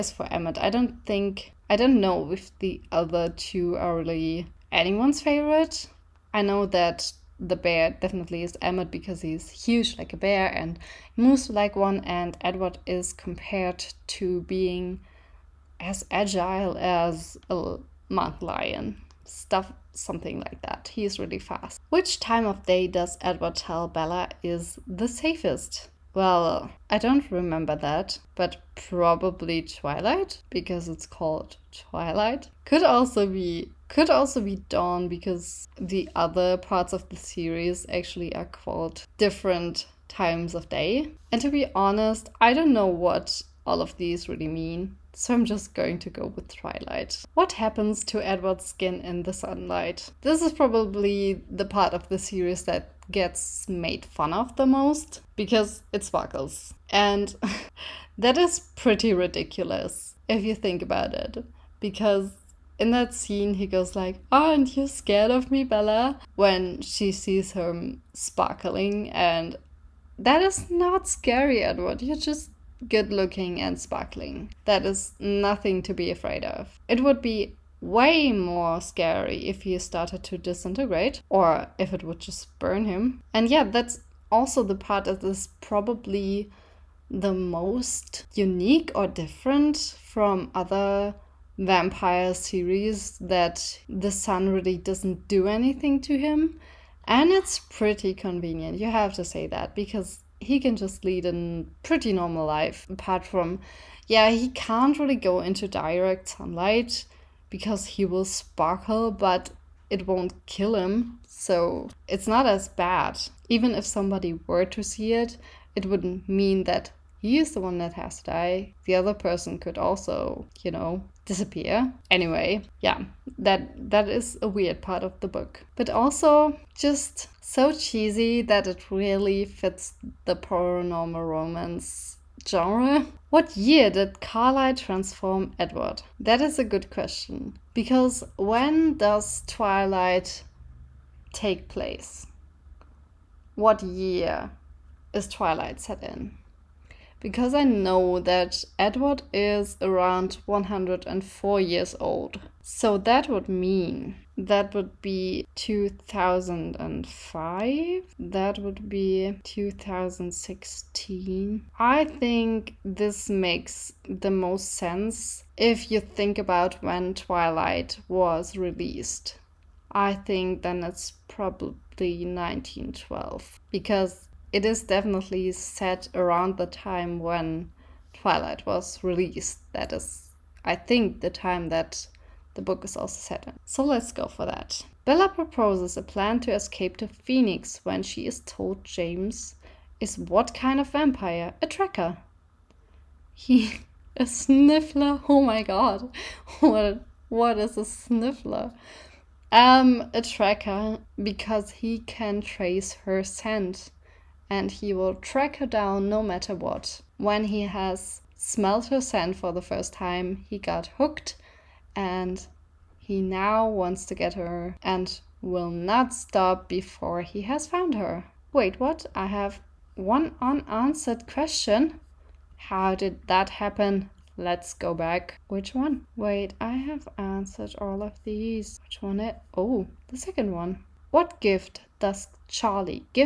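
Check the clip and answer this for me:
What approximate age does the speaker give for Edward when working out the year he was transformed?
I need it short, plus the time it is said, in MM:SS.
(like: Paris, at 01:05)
104, at 02:30.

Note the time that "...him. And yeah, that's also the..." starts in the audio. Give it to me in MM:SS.
01:22.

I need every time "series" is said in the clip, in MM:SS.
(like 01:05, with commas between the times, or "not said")
00:37, 00:52, 01:32.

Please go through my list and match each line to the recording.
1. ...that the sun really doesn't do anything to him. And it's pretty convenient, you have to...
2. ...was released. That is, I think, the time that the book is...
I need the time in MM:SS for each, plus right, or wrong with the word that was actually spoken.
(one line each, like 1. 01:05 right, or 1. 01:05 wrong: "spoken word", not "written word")
1. 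01:33 right
2. 02:58 right.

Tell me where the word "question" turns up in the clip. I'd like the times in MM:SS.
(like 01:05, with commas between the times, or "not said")
02:16, 03:41.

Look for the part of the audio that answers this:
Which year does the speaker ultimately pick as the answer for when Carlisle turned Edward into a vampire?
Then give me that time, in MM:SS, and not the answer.
02:52.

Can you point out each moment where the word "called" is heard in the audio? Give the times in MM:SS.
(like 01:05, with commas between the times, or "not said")
00:31, 00:38.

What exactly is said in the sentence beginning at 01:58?
The other person could also, you know, disappear.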